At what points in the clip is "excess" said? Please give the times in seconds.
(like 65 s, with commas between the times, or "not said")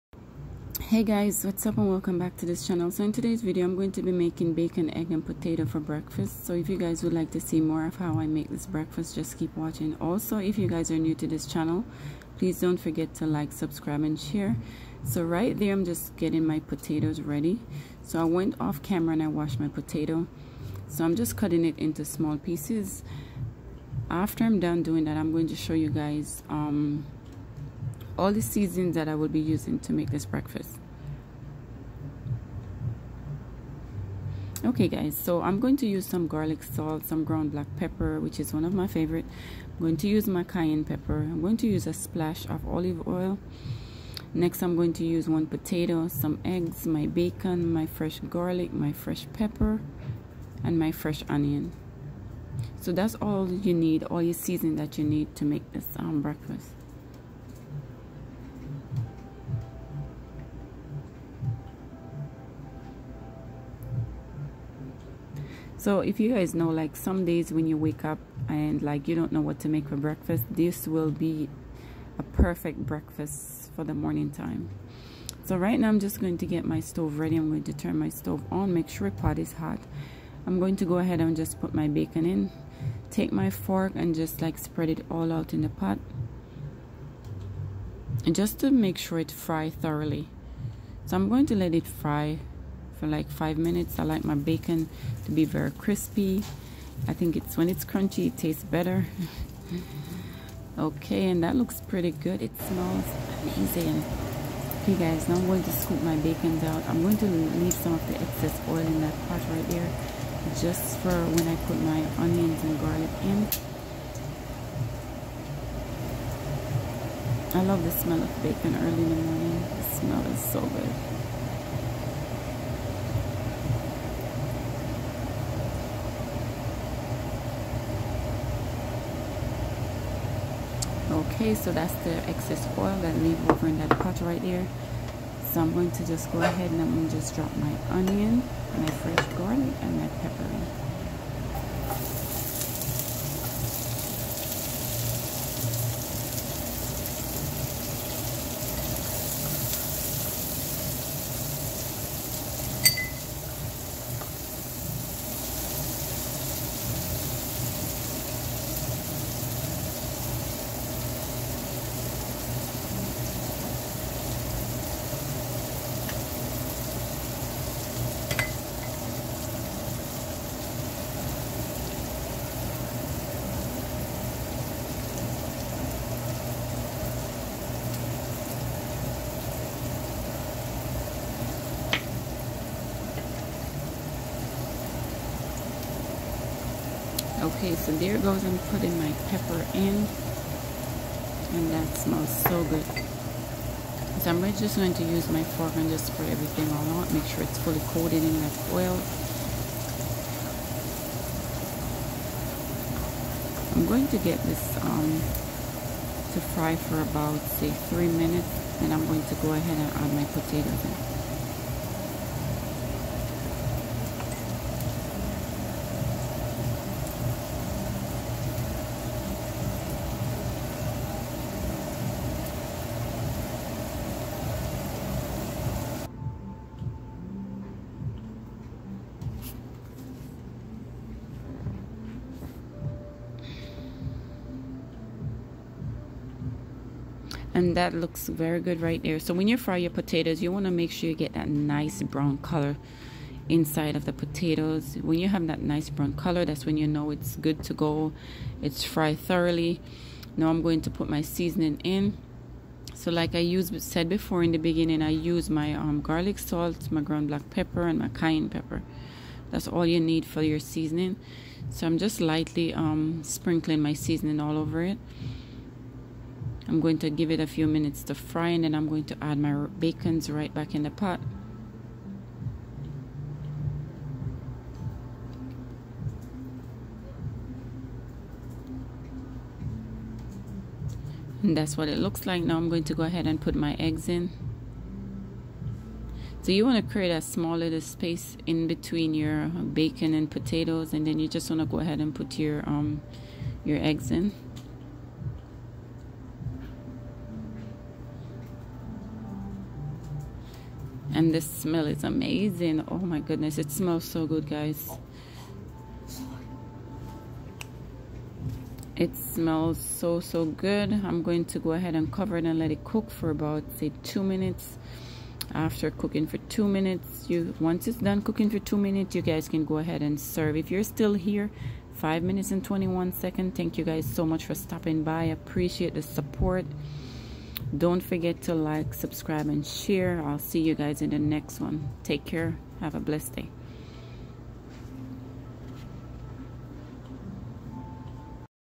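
108 s, 132 s.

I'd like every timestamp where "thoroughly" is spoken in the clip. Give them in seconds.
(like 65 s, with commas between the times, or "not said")
89 s, 249 s.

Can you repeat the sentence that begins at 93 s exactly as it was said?
I like my bacon to be very crispy.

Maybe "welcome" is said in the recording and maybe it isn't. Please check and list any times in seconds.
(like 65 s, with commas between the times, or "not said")
1 s.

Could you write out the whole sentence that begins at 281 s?
And that's what it looks like.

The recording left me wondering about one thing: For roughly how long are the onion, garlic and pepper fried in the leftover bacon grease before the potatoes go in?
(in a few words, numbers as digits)
3 minutes.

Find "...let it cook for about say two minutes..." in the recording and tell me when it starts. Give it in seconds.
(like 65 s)
312 s.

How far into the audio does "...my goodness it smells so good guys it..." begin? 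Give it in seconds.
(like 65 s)
302 s.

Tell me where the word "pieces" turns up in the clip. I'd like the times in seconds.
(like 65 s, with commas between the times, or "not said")
22 s.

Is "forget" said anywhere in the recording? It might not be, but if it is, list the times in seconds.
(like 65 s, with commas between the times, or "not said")
12 s, 328 s.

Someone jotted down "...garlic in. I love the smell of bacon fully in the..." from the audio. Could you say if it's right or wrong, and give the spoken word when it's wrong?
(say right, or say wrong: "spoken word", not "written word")
wrong: "early", not "fully".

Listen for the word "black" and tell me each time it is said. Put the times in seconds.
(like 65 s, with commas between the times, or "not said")
37 s, 257 s.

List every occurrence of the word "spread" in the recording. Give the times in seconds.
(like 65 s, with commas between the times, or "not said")
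84 s, 196 s.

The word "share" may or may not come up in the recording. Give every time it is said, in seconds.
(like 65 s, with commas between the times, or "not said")
14 s, 329 s.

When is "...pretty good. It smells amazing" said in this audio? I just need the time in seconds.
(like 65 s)
101 s.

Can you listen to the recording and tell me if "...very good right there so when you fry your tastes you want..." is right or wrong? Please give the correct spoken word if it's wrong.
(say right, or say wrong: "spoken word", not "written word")
wrong: "potatoes", not "tastes".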